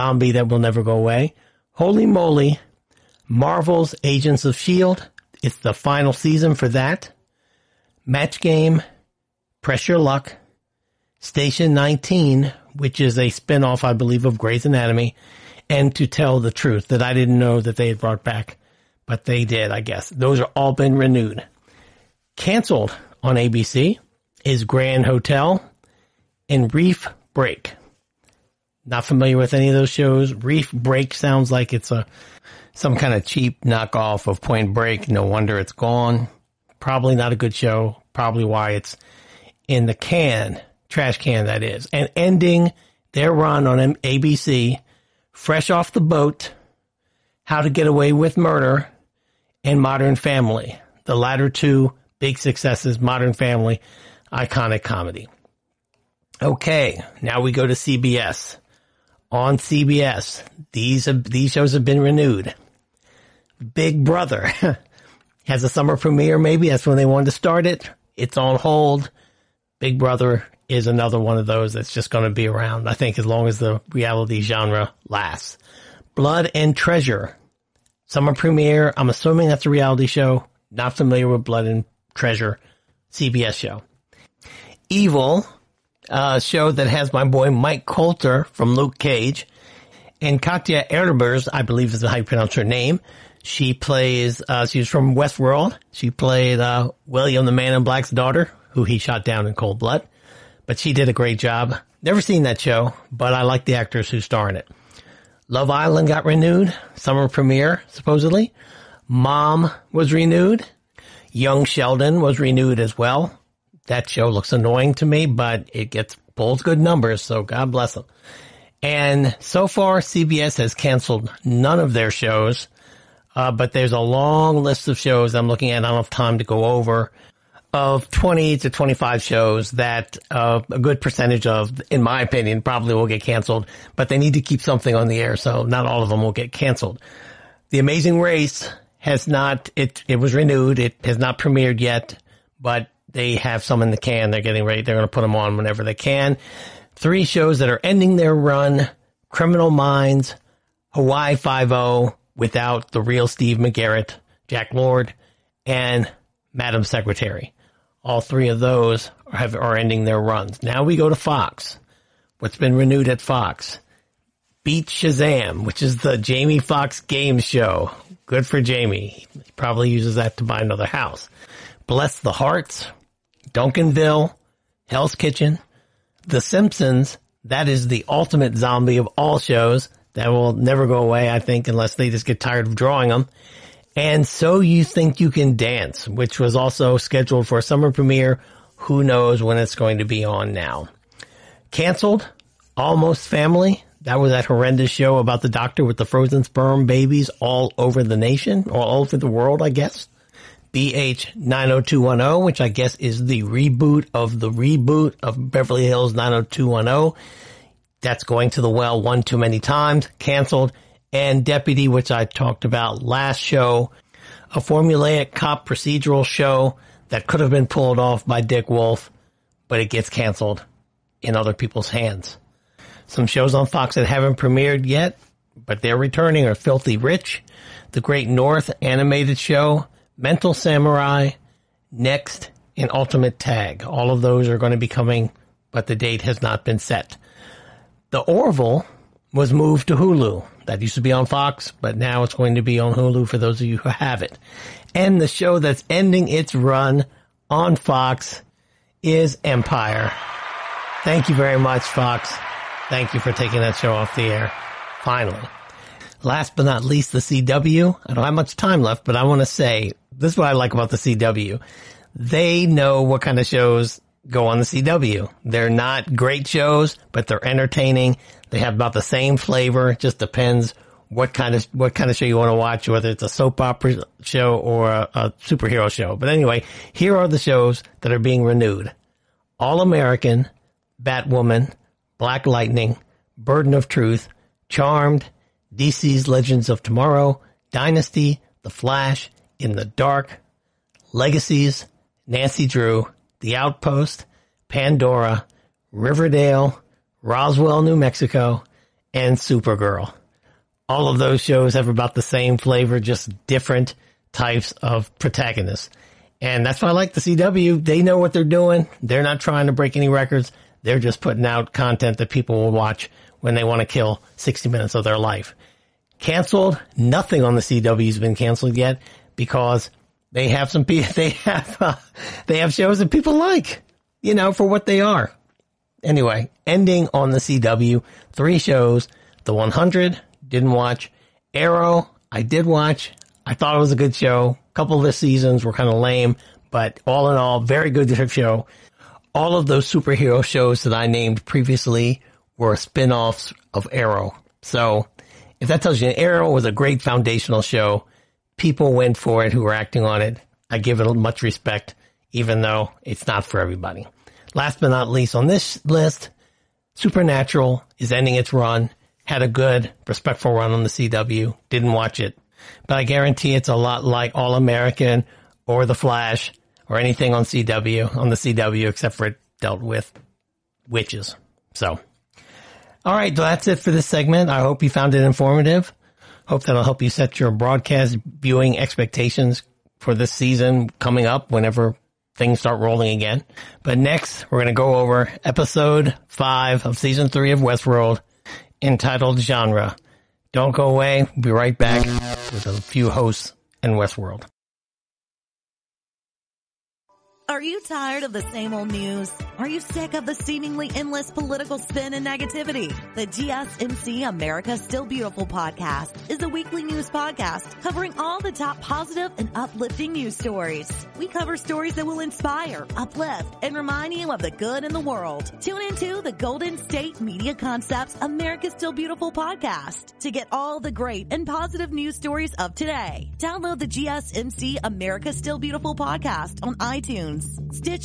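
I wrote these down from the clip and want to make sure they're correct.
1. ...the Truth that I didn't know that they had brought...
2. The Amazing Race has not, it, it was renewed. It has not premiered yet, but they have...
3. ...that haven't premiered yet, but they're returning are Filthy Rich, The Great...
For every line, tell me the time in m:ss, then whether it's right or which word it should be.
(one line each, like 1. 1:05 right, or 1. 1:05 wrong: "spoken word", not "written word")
1. 0:16 right
2. 2:17 right
3. 3:43 right.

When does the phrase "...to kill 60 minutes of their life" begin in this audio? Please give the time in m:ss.
5:13.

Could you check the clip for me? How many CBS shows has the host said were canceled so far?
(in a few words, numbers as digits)
None.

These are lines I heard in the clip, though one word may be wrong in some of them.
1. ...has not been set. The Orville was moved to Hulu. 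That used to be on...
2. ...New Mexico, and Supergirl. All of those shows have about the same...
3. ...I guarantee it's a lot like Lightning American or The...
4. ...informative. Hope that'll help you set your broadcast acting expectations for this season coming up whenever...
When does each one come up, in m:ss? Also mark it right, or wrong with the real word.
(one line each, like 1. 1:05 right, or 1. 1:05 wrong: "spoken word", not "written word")
1. 3:56 right
2. 4:57 right
3. 6:02 wrong: "All", not "Lightning"
4. 6:15 wrong: "viewing", not "acting".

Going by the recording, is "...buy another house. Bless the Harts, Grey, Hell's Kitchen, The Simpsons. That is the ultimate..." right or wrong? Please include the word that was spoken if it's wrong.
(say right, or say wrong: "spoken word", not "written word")
wrong: "Duncanville", not "Grey".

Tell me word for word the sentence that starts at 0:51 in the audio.
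The latter two big successes, Modern Family, iconic comedy.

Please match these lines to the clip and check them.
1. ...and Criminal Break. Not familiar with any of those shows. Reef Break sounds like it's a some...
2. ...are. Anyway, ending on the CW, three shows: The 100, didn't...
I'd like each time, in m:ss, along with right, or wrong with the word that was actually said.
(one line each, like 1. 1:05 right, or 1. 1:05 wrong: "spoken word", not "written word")
1. 0:26 wrong: "Reef", not "Criminal"
2. 5:25 right.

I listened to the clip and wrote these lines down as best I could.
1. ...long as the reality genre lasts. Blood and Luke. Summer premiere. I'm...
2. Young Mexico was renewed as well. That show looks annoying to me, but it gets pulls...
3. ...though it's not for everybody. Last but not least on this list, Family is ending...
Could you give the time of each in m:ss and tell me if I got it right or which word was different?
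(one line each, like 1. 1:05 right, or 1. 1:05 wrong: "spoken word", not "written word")
1. 1:13 wrong: "Treasure", not "Luke"
2. 1:51 wrong: "Sheldon", not "Mexico"
3. 5:52 wrong: "Supernatural", not "Family".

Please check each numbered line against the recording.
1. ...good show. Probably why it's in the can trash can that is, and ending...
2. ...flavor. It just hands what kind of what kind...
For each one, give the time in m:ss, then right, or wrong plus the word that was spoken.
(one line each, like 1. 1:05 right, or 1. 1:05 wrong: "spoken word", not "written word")
1. 0:37 right
2. 4:29 wrong: "depends", not "hands".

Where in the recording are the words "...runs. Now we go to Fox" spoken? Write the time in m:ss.
2:40.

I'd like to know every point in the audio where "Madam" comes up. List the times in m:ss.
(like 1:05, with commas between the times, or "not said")
2:36.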